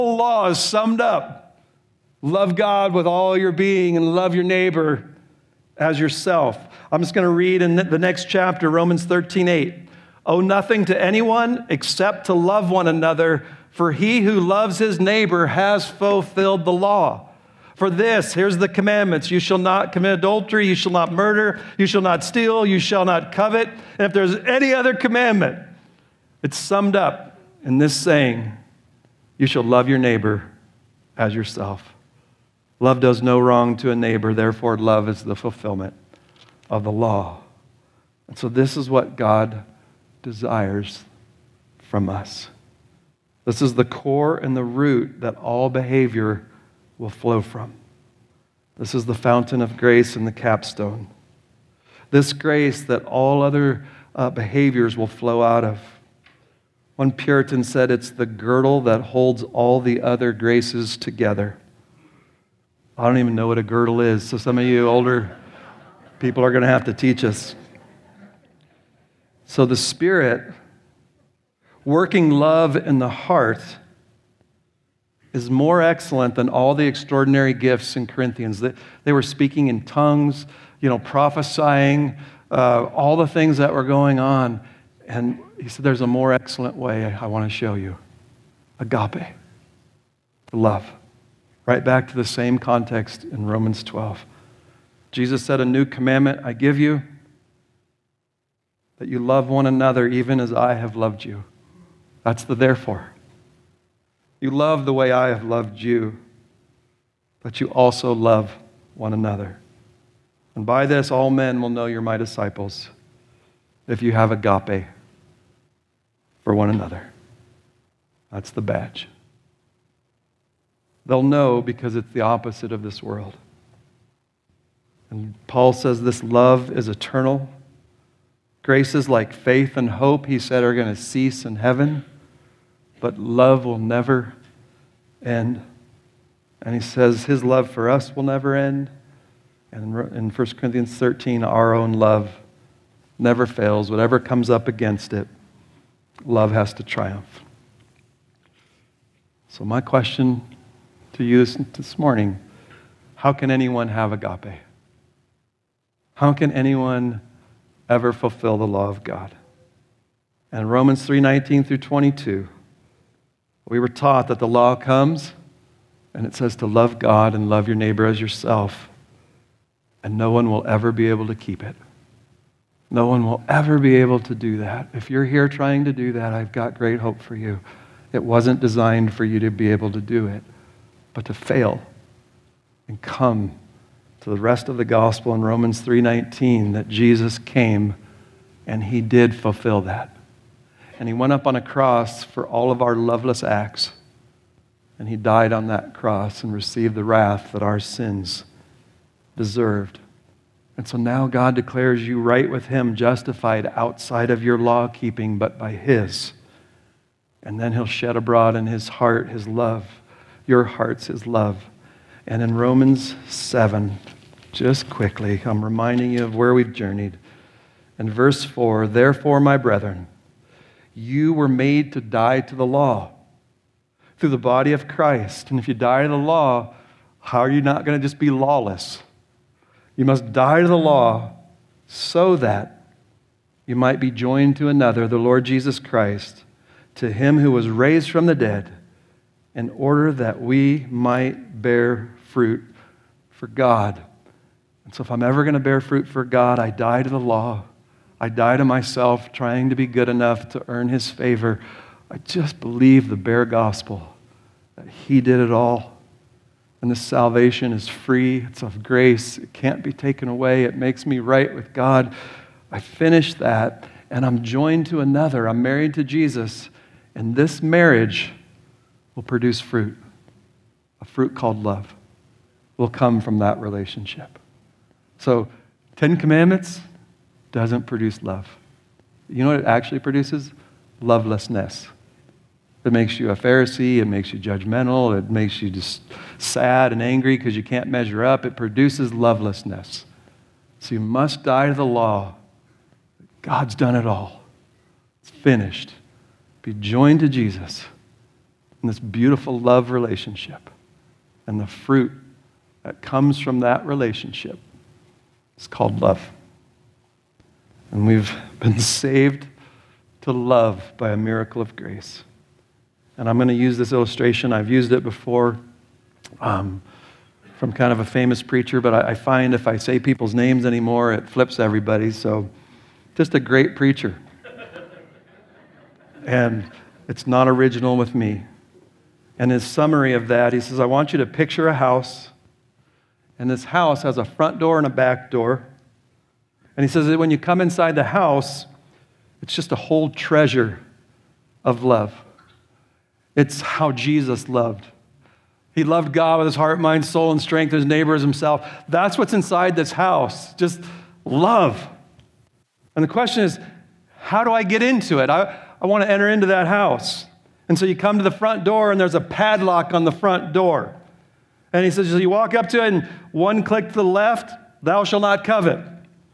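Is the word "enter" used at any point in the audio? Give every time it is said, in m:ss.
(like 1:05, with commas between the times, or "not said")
5:56.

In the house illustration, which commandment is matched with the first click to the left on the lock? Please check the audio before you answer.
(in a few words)
Thou shalt not covet.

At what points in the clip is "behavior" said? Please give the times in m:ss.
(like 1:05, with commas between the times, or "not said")
0:45, 0:54.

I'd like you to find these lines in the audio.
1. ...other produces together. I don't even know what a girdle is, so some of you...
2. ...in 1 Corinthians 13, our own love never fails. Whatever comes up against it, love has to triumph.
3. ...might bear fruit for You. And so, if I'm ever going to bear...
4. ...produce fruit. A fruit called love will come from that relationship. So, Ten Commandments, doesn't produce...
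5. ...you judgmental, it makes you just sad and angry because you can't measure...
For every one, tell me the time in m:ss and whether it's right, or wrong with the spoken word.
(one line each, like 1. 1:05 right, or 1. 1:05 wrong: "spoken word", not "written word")
1. 1:00 wrong: "graces", not "produces"
2. 2:20 right
3. 4:00 wrong: "God", not "You"
4. 4:29 right
5. 4:44 right.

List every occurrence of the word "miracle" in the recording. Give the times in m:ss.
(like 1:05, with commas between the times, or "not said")
5:11.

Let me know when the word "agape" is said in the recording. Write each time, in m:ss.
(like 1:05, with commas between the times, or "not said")
1:28, 1:54, 2:34.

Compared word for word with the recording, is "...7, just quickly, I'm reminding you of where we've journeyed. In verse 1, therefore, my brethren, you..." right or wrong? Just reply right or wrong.
wrong.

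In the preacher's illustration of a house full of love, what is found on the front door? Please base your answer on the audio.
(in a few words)
A padlock.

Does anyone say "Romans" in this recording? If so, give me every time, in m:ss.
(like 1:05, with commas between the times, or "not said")
0:08, 1:33, 2:40, 3:05, 3:32.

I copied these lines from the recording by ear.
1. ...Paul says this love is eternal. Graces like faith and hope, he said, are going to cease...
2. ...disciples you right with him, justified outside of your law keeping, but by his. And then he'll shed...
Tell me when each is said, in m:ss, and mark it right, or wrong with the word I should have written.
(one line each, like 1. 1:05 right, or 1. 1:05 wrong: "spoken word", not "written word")
1. 2:05 right
2. 3:21 wrong: "declares", not "disciples".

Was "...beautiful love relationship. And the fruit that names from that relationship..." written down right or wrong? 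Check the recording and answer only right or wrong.
wrong.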